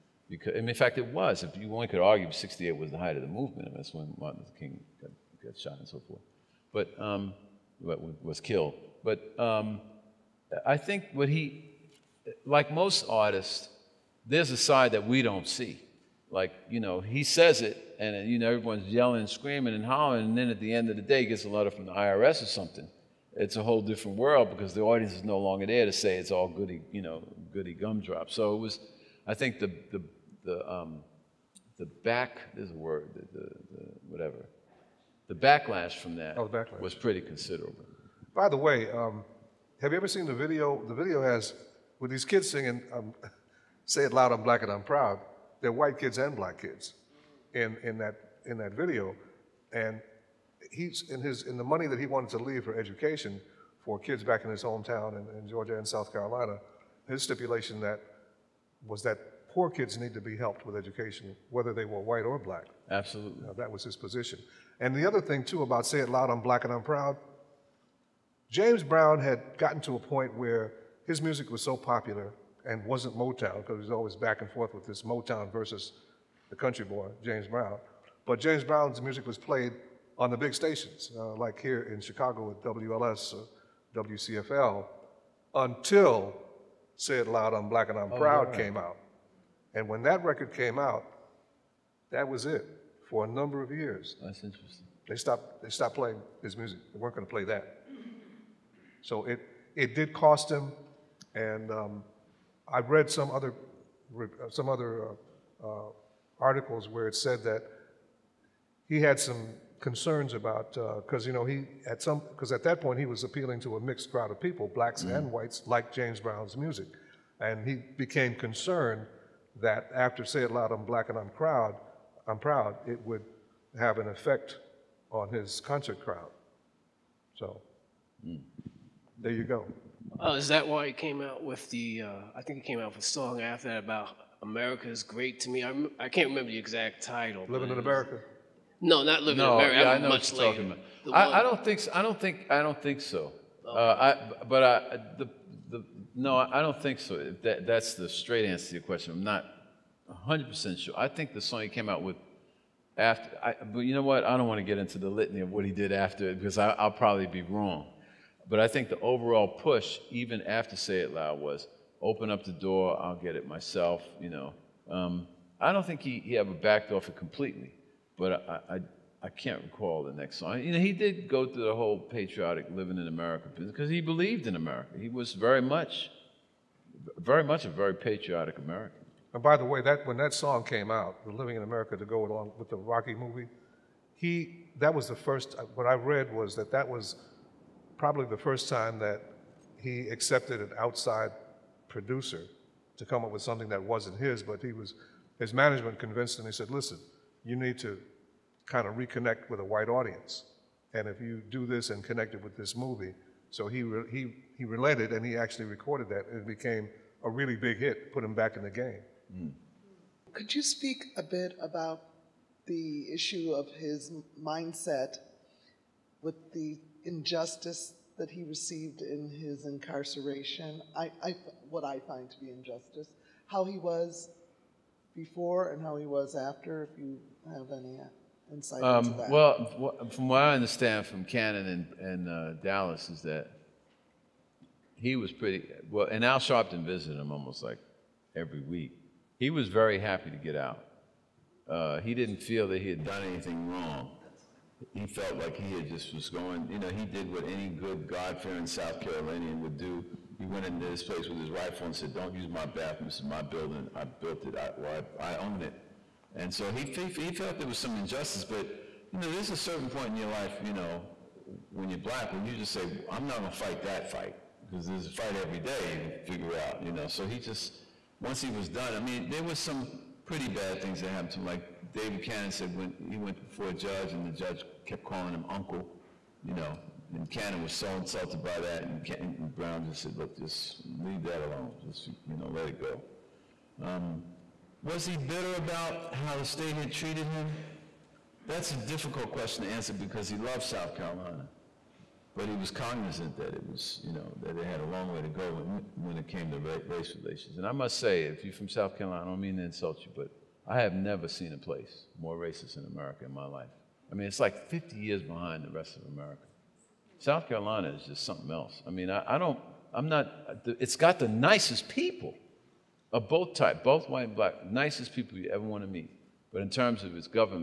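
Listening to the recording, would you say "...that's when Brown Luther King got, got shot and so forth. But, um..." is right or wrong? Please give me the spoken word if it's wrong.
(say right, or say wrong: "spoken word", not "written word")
wrong: "Martin", not "Brown".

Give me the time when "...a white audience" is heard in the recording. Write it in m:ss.
3:19.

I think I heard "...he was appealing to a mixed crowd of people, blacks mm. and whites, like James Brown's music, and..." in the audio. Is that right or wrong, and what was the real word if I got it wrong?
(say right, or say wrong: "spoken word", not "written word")
right.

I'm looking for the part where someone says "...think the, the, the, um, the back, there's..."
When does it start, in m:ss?
0:29.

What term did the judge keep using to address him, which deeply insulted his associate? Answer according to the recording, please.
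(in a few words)
uncle.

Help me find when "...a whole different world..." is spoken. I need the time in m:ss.
0:23.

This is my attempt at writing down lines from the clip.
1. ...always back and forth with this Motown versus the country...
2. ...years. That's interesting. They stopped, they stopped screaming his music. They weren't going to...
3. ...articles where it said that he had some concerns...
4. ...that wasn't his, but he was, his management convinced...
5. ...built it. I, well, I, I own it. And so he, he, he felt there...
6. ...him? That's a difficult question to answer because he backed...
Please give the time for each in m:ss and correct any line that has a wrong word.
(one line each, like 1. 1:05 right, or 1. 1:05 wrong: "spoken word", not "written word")
1. 1:13 right
2. 1:33 wrong: "playing", not "screaming"
3. 1:46 right
4. 3:13 right
5. 4:14 right
6. 4:47 wrong: "loved", not "backed".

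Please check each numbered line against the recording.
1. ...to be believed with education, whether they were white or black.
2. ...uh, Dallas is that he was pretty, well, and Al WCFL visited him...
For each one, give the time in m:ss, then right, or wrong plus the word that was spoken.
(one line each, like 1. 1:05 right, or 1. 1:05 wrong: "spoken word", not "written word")
1. 1:00 wrong: "helped", not "believed"
2. 3:52 wrong: "Sharpton", not "WCFL".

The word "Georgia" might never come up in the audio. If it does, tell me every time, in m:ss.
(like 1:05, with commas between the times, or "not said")
0:55.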